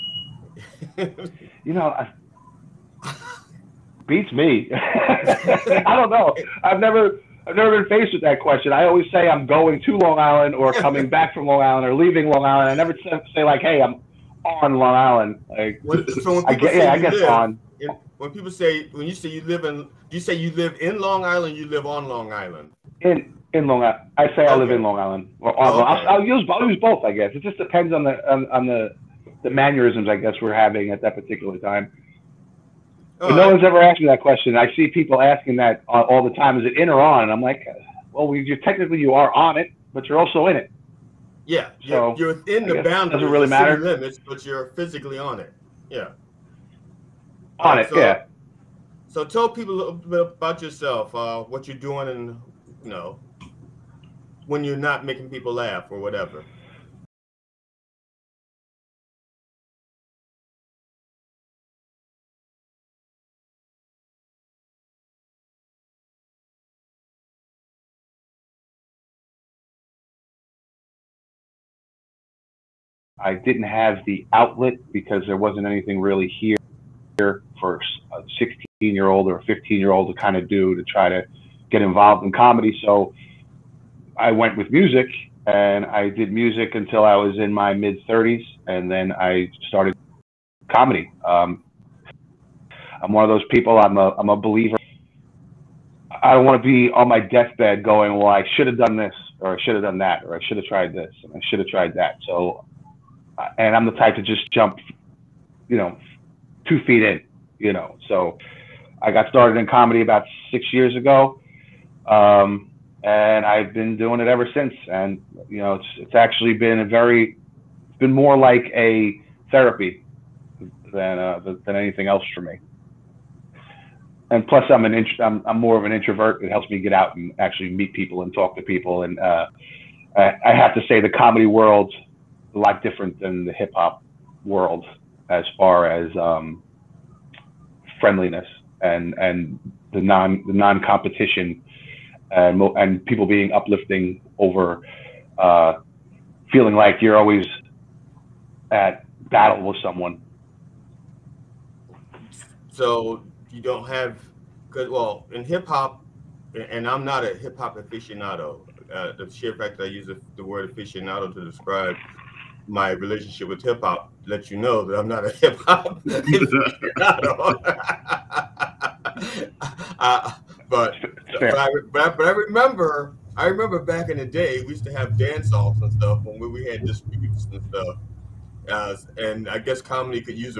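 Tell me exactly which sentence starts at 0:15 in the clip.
Like, when, so I guess, yeah, I guess live, on.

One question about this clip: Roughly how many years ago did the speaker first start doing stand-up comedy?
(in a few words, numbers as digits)
6 years.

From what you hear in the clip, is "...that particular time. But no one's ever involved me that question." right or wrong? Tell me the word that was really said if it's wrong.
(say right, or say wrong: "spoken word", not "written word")
wrong: "asked", not "involved".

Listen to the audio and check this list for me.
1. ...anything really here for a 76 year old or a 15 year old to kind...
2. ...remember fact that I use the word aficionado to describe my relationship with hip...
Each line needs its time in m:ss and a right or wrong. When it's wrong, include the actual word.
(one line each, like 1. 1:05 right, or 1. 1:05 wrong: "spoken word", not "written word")
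1. 1:15 wrong: "16", not "76"
2. 2:39 wrong: "sheer", not "remember".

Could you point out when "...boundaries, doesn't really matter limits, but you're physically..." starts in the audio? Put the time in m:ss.
0:42.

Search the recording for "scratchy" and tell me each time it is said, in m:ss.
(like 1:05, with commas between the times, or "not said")
not said.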